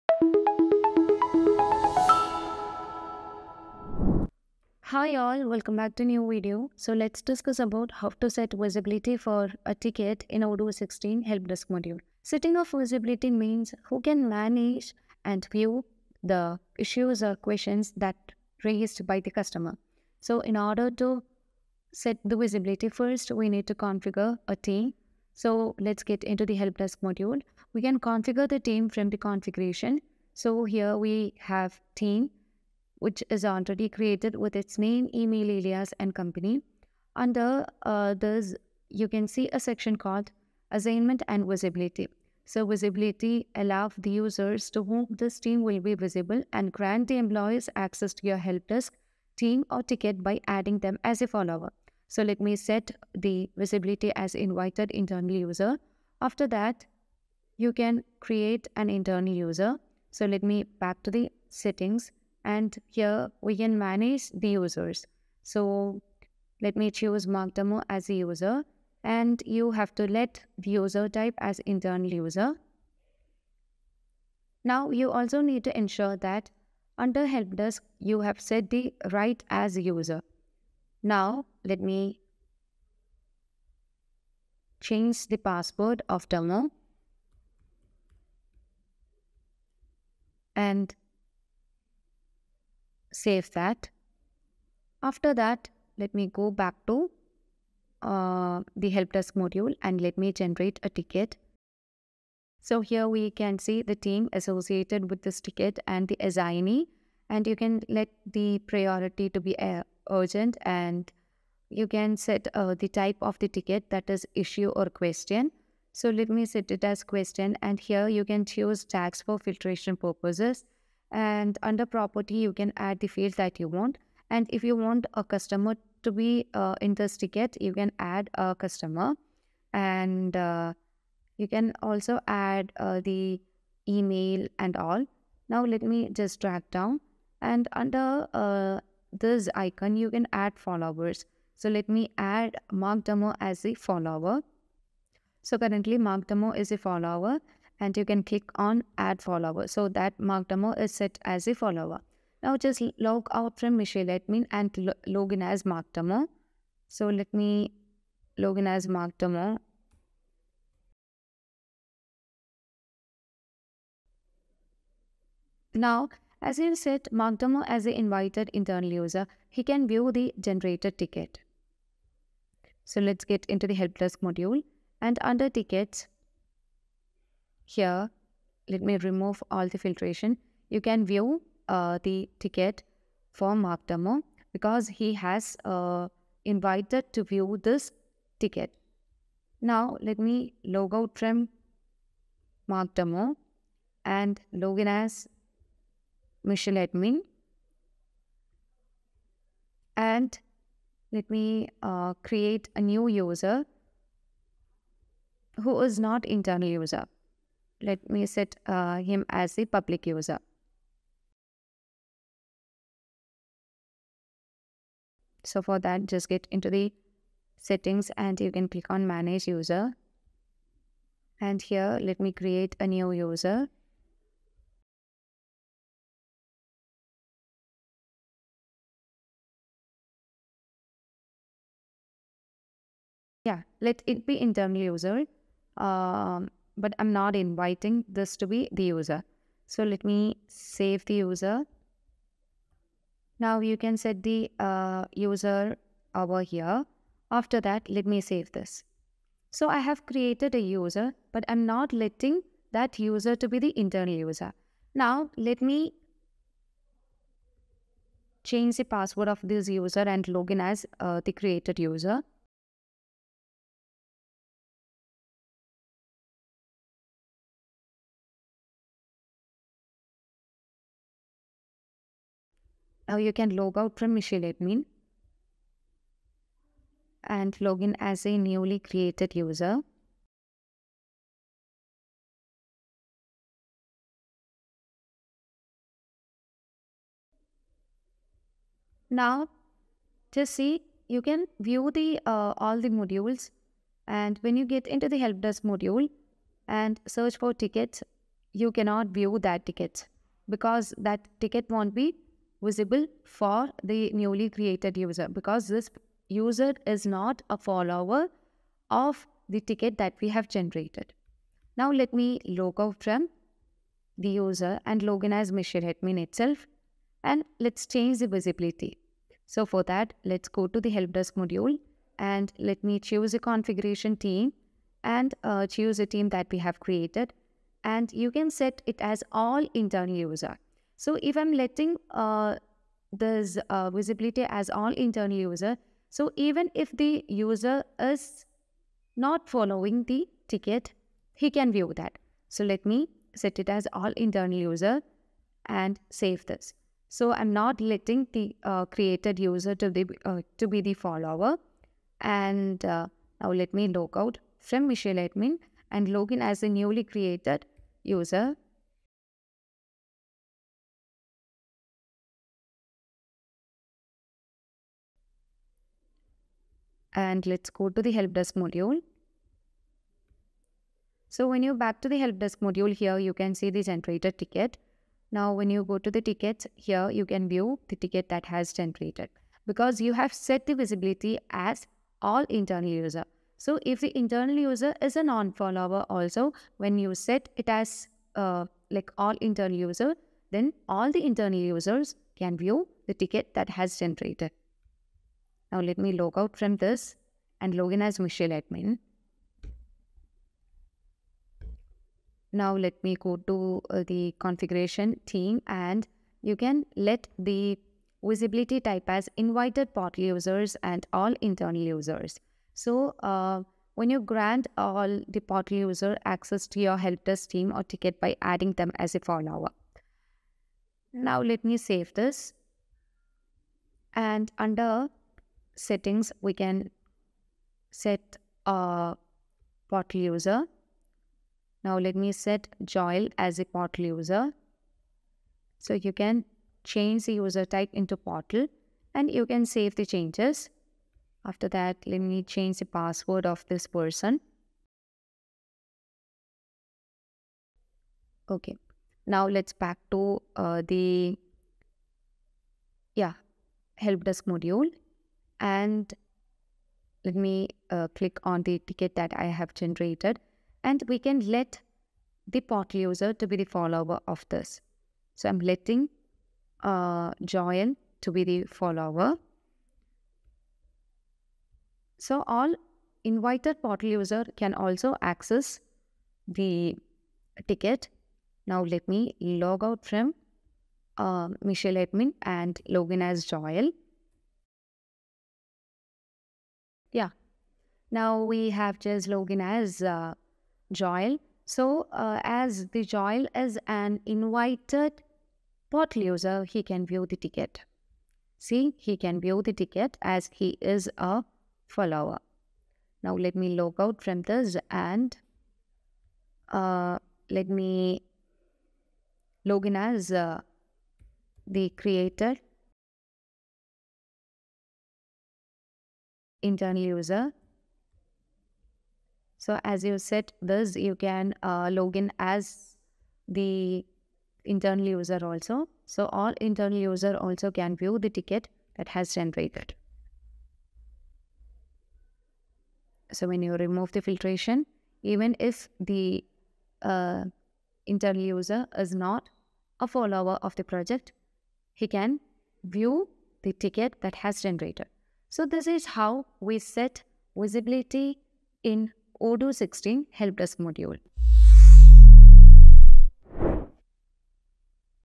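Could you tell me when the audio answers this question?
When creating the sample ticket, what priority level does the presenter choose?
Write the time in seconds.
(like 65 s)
110 s.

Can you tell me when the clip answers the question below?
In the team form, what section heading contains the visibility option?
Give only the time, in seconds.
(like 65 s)
40 s.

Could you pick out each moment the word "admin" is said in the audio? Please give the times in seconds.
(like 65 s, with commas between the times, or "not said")
154 s, 196 s, 274 s, 315 s, 355 s, 398 s, 481 s.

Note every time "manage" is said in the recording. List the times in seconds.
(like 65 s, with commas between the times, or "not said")
14 s, 63 s, 219 s.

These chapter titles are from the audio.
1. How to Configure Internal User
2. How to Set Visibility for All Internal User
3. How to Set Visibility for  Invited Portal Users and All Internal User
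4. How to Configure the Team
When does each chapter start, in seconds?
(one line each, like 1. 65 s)
1. 61 s
2. 310 s
3. 374 s
4. 28 s.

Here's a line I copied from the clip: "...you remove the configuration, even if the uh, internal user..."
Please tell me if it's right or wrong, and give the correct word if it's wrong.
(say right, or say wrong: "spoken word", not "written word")
wrong: "filtration", not "configuration".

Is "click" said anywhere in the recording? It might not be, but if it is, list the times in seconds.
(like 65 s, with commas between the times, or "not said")
148 s, 218 s, 458 s.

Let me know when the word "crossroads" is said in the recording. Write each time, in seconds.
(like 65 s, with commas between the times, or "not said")
not said.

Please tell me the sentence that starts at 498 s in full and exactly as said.
See, he can view the ticket as he is a follower.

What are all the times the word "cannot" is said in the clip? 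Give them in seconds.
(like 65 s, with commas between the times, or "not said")
298 s.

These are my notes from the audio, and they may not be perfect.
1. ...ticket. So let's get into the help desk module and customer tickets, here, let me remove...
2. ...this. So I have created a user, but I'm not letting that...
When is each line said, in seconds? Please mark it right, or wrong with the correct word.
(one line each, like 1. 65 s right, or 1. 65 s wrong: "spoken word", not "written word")
1. 170 s wrong: "under", not "customer"
2. 248 s right.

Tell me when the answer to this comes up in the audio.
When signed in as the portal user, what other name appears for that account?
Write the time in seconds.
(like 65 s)
488 s.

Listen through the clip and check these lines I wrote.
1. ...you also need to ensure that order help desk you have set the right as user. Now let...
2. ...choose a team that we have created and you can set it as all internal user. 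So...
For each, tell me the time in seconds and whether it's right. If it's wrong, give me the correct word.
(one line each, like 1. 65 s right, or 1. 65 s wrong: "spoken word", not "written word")
1. 74 s wrong: "under", not "order"
2. 325 s right.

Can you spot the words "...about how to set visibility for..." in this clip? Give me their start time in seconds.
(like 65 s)
7 s.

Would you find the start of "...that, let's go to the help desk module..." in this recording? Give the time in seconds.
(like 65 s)
319 s.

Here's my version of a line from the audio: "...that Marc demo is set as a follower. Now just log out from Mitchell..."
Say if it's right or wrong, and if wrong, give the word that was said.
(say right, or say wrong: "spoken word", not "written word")
right.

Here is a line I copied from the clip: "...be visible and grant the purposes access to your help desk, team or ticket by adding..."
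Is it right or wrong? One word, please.
wrong.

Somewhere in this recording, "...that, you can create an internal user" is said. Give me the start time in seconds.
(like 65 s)
56 s.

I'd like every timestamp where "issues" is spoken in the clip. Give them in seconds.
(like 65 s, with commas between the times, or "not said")
16 s, 114 s.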